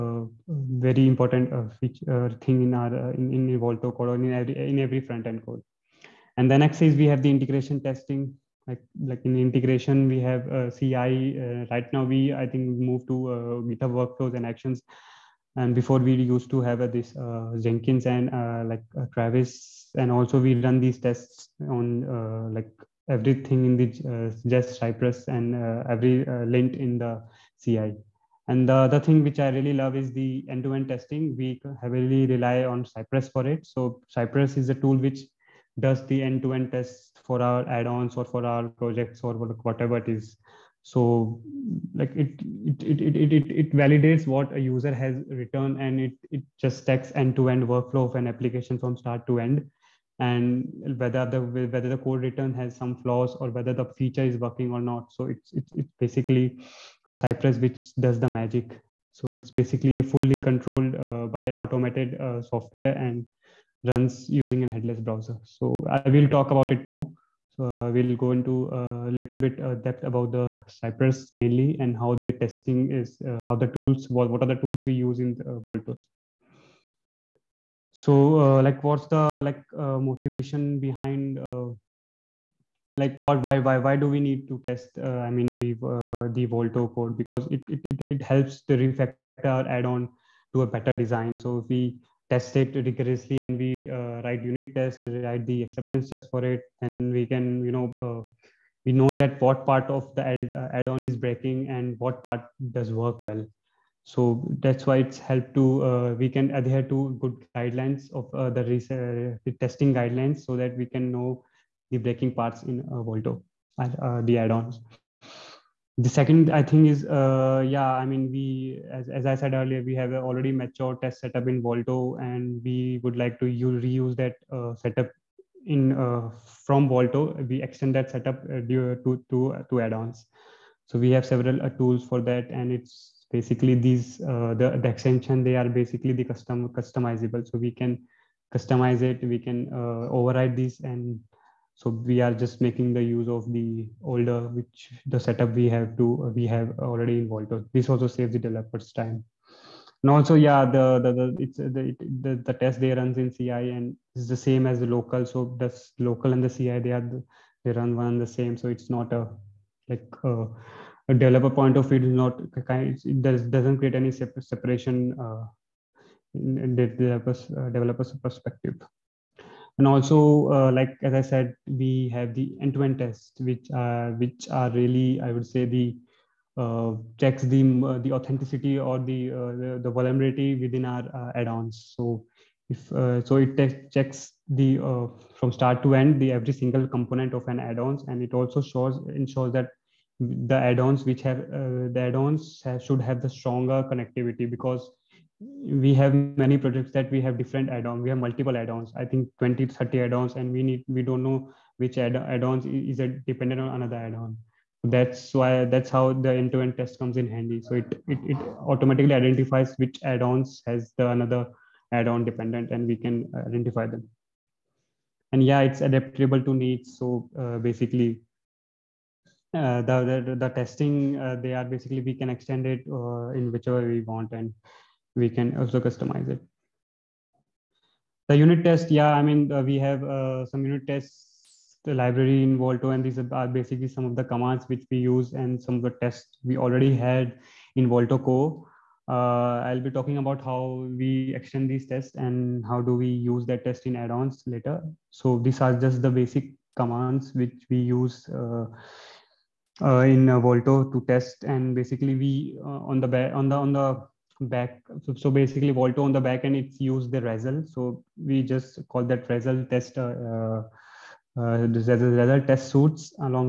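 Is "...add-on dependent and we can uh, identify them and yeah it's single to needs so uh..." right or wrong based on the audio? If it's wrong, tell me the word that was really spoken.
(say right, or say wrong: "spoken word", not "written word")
wrong: "adaptable", not "single".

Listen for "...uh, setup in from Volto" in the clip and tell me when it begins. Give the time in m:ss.
2:04.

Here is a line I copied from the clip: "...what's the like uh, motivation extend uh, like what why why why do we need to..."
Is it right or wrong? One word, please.
wrong.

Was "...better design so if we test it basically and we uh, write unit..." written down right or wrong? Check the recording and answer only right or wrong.
wrong.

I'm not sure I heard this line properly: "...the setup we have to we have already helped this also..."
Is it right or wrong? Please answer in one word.
wrong.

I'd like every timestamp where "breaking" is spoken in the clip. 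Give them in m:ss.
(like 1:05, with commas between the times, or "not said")
1:41, 1:51.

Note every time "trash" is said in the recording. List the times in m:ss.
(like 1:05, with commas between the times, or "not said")
not said.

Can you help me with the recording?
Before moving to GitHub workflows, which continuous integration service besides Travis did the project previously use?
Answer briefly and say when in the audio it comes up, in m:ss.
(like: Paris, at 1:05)
Jenkins, at 0:17.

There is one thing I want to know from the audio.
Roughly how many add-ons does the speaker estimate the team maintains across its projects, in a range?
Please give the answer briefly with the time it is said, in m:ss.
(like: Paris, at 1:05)
20 to 30, at 3:19.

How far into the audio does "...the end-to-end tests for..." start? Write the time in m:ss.
0:36.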